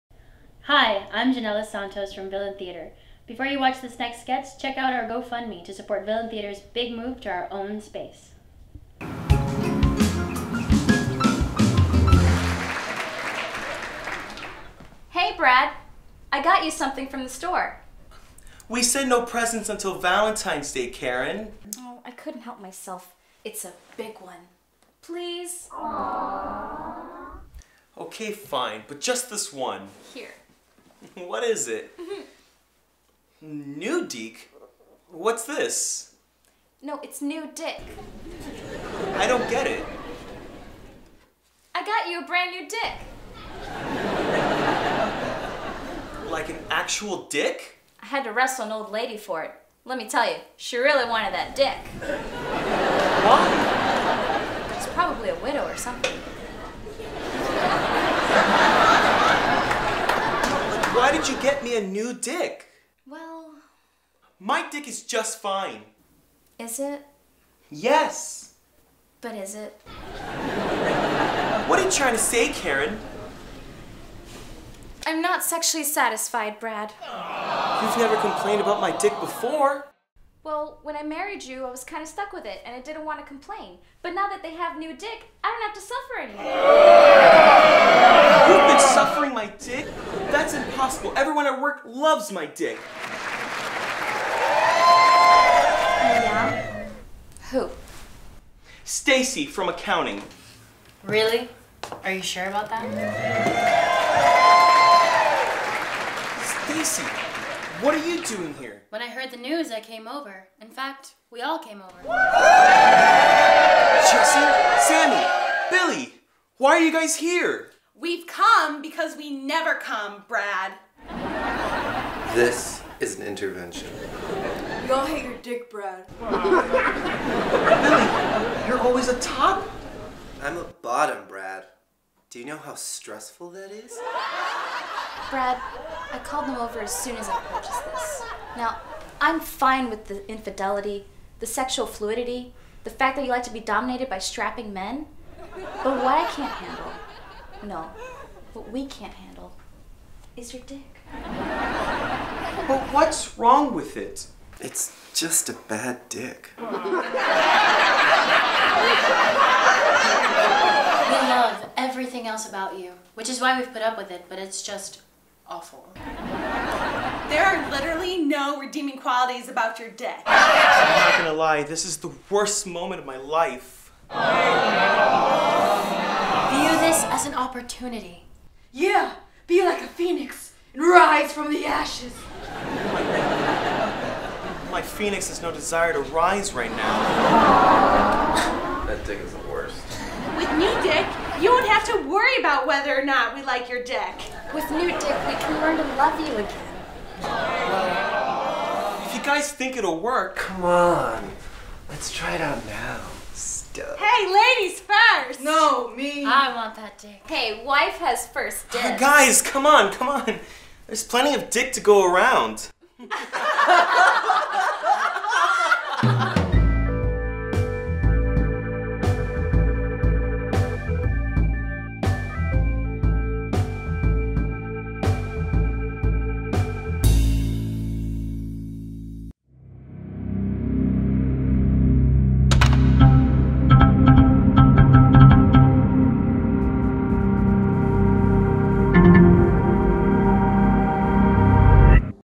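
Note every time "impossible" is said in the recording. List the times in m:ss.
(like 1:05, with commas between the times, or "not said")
1:30.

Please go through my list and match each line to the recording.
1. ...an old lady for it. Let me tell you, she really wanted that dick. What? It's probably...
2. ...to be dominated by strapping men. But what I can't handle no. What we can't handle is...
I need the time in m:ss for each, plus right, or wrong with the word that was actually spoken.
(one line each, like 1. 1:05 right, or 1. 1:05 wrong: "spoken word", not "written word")
1. 0:48 right
2. 2:23 right.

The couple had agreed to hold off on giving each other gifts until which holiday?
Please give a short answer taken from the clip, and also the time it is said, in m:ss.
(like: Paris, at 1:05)
Valentine's Day, at 0:19.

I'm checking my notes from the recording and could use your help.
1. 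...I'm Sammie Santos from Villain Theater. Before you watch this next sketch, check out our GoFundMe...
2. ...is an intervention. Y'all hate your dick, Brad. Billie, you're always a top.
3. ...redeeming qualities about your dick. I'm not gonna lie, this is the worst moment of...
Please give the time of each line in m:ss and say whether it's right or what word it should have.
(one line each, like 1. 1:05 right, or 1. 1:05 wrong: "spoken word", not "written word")
1. 0:01 wrong: "Jannelys", not "Sammie"
2. 2:02 right
3. 2:48 right.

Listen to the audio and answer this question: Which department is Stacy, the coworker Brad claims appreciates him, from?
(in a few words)
Accounting.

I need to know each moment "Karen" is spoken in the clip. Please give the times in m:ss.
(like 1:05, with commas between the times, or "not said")
0:20, 1:12.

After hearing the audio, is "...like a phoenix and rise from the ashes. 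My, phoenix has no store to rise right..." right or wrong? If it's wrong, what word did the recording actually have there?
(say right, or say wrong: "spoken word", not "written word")
wrong: "desire", not "store".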